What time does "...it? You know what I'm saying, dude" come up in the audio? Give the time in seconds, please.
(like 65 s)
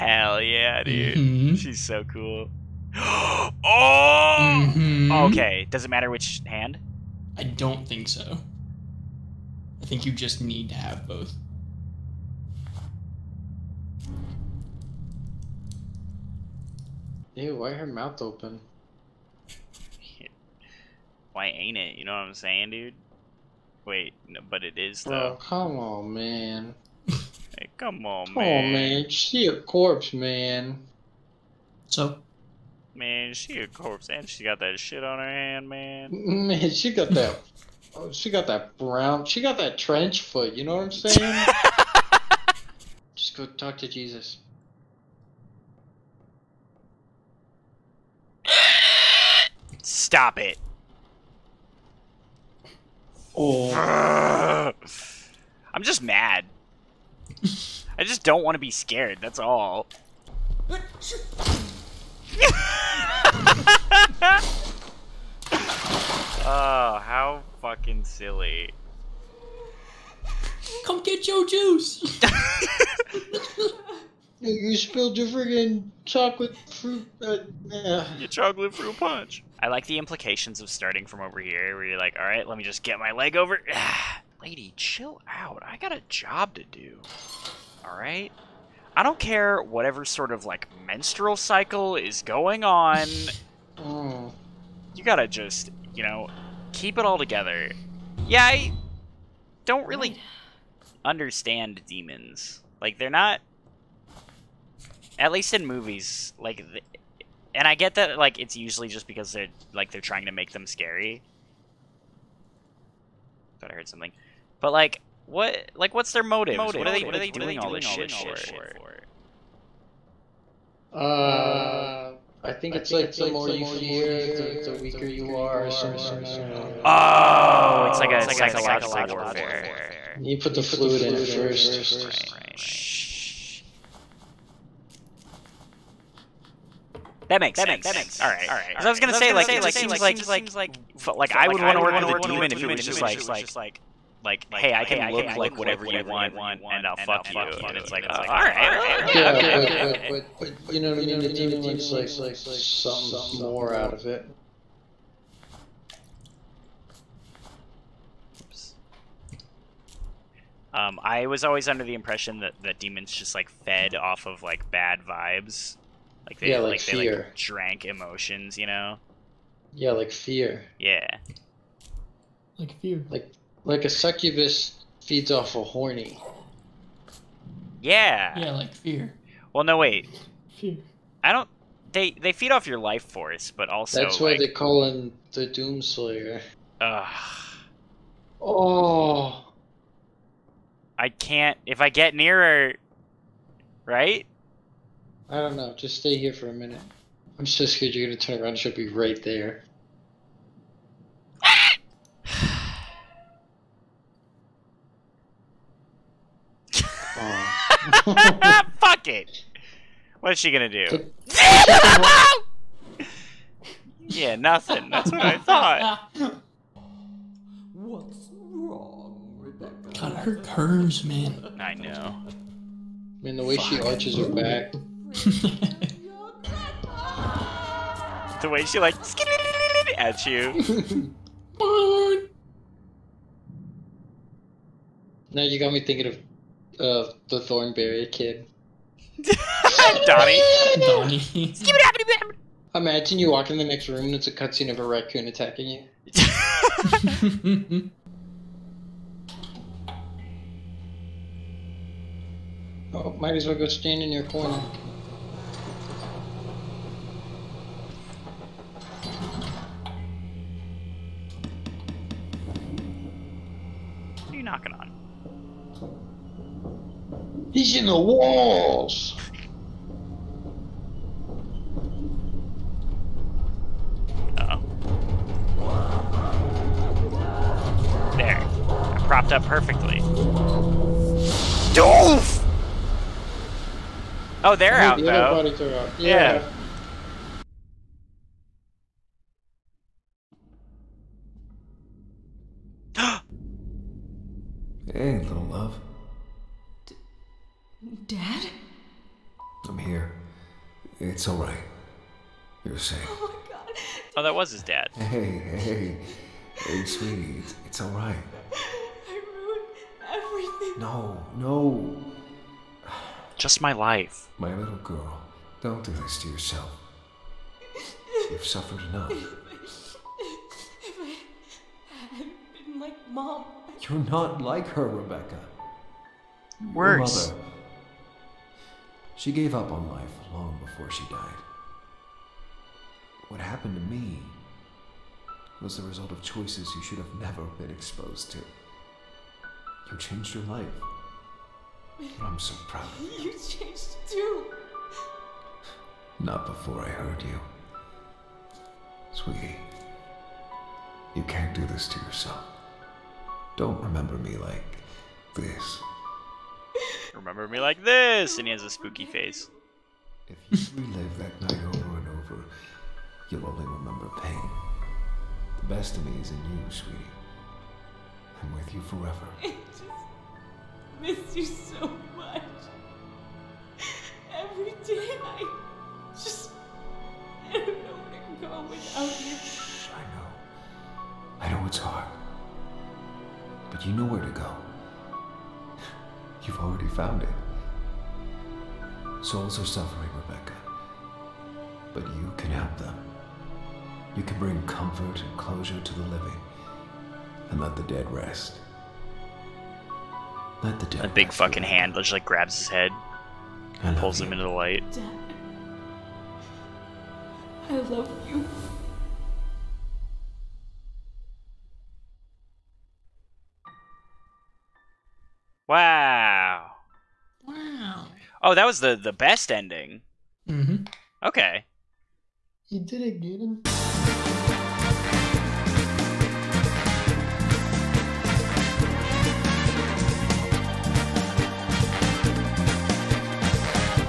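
21 s.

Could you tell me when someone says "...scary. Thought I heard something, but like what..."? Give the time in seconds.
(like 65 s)
110 s.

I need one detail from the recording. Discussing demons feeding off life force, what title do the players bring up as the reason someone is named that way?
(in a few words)
Doomslayer.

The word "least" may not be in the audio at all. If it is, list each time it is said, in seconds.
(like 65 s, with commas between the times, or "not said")
105 s.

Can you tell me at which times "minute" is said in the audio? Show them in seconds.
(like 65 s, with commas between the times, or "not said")
196 s.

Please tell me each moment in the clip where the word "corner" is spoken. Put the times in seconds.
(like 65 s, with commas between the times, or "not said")
254 s.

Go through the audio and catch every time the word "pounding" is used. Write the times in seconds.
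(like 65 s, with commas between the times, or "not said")
not said.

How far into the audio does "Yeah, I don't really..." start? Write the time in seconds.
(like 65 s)
98 s.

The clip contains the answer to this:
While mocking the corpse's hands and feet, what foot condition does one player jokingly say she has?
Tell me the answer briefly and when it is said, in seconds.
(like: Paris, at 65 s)
trench foot, at 39 s.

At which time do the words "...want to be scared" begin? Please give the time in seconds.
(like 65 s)
58 s.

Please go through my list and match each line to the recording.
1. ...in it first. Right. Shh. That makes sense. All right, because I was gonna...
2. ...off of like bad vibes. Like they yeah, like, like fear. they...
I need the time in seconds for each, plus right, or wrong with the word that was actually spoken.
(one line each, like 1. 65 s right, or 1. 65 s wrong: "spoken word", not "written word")
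1. 131 s right
2. 163 s right.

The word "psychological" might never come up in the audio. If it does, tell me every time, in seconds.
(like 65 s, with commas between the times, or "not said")
128 s.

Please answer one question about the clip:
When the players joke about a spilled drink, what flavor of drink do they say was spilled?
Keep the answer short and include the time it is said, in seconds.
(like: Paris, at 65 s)
chocolate fruit punch, at 78 s.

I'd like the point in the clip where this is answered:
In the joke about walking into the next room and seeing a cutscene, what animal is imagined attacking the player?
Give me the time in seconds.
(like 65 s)
244 s.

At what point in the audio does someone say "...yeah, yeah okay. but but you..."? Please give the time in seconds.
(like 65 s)
149 s.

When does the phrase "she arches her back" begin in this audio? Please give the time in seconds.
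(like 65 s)
223 s.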